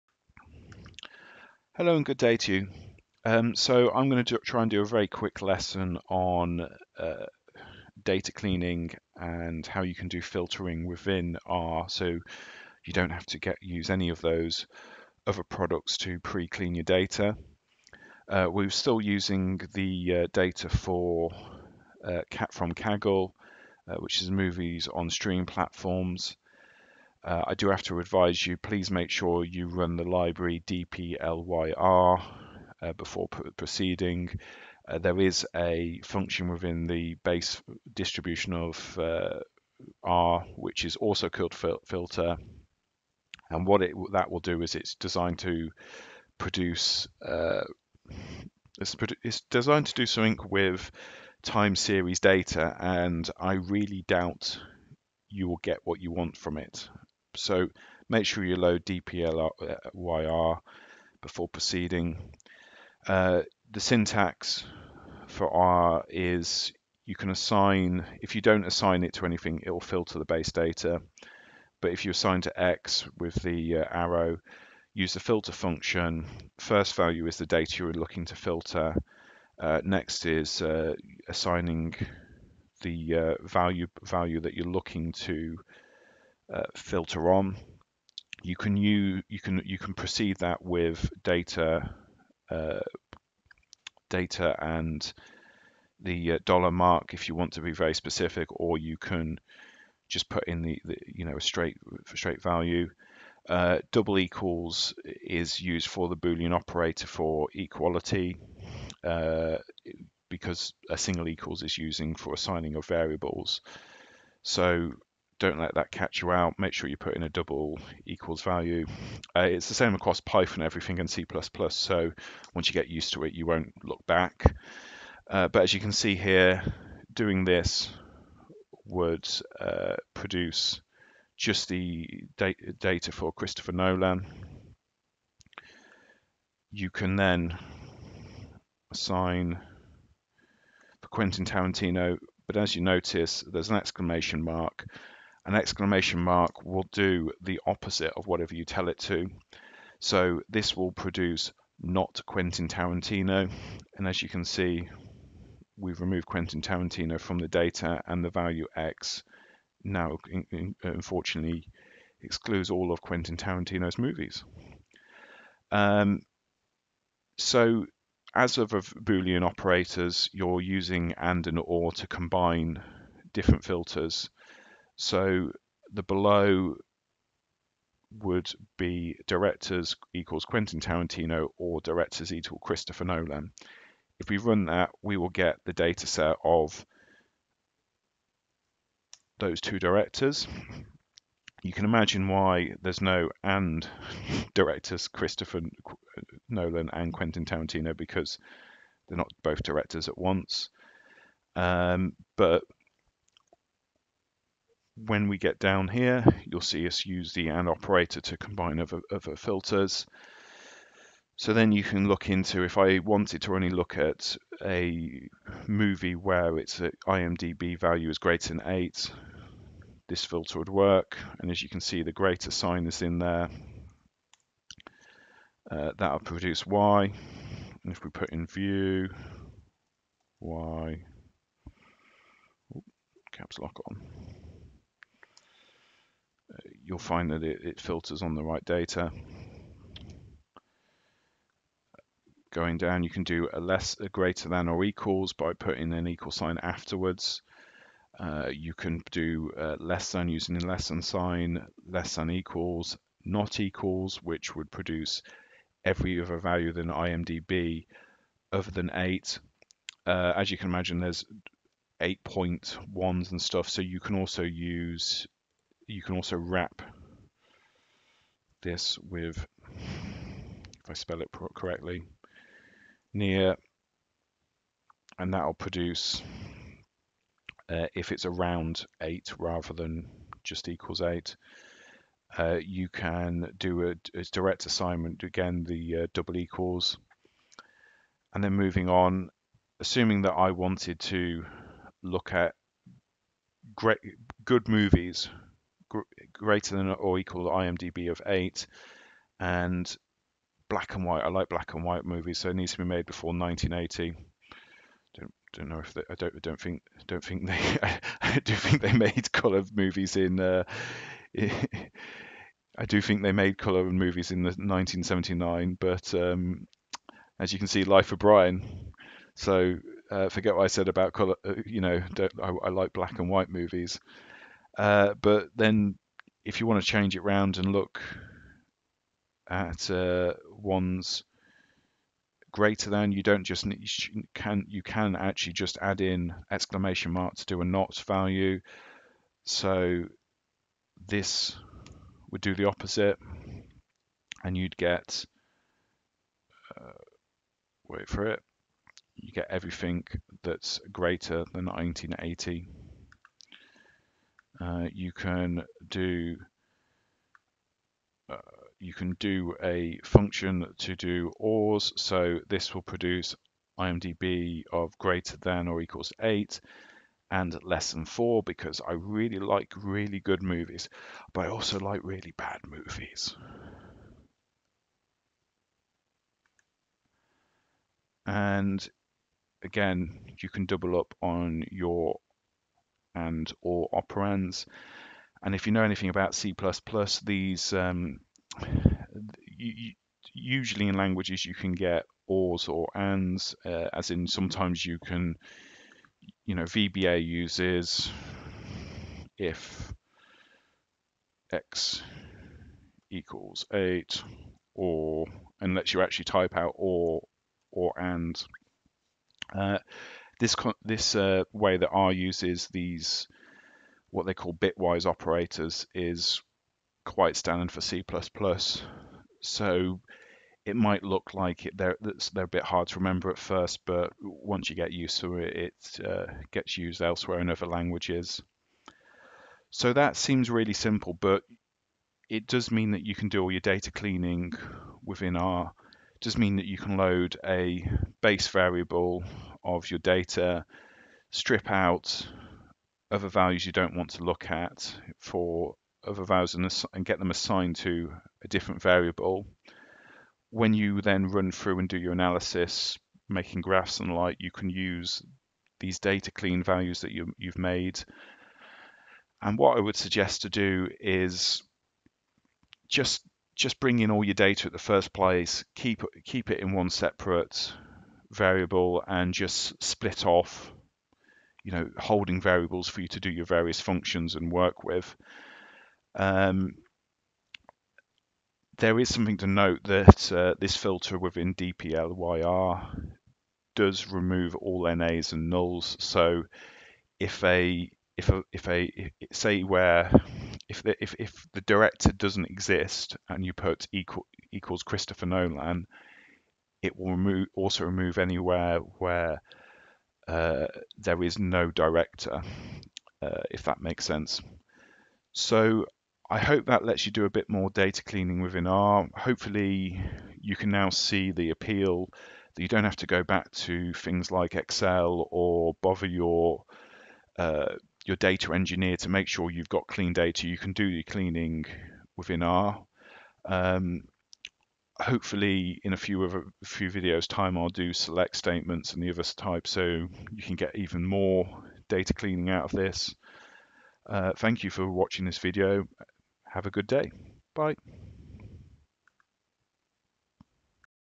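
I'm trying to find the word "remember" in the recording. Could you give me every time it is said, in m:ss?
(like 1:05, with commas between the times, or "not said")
7:02.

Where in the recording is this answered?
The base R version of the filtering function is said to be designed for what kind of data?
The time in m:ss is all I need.
0:51.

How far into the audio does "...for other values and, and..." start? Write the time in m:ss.
7:25.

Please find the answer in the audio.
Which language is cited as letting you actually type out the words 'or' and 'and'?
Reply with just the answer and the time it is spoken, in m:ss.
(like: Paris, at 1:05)
VBA, at 6:36.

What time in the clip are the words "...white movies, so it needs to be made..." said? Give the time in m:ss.
5:01.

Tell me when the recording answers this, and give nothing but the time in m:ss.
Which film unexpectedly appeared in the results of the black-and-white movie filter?
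5:17.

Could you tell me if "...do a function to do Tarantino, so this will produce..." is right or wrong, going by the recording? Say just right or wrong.
wrong.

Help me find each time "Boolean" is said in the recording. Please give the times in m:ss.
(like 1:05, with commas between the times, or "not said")
1:46, 2:48.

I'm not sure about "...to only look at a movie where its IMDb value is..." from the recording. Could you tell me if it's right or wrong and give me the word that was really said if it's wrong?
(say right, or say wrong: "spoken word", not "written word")
right.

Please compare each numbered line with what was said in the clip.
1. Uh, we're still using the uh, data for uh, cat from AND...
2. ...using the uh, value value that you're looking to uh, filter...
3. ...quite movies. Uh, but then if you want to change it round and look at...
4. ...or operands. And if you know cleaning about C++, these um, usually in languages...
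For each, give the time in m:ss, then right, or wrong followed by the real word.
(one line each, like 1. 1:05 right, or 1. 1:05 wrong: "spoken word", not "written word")
1. 0:18 wrong: "Kaggle", not "AND"
2. 1:21 wrong: "assigning", not "using"
3. 5:23 wrong: "white", not "quite"
4. 6:23 wrong: "anything", not "cleaning".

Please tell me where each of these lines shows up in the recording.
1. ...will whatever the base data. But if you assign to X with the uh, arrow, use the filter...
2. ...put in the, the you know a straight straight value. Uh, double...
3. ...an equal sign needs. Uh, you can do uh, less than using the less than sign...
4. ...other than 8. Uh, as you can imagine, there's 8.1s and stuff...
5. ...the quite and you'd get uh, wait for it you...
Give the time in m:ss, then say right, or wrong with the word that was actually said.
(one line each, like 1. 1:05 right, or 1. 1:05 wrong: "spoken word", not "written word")
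1. 1:09 wrong: "filter", not "whatever"
2. 1:40 right
3. 4:05 wrong: "afterwards", not "needs"
4. 4:18 right
5. 5:42 wrong: "opposite", not "quite".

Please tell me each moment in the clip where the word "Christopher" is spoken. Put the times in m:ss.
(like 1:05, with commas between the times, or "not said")
2:13, 3:02, 3:15, 8:14.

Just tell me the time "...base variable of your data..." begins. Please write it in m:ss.
7:18.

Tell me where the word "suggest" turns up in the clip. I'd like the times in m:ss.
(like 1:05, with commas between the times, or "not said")
7:39.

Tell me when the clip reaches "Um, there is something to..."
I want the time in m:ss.
7:56.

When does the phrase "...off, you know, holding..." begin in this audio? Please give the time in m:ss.
7:50.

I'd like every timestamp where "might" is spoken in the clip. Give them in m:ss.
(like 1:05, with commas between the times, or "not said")
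7:00.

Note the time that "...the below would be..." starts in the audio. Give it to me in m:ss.
2:55.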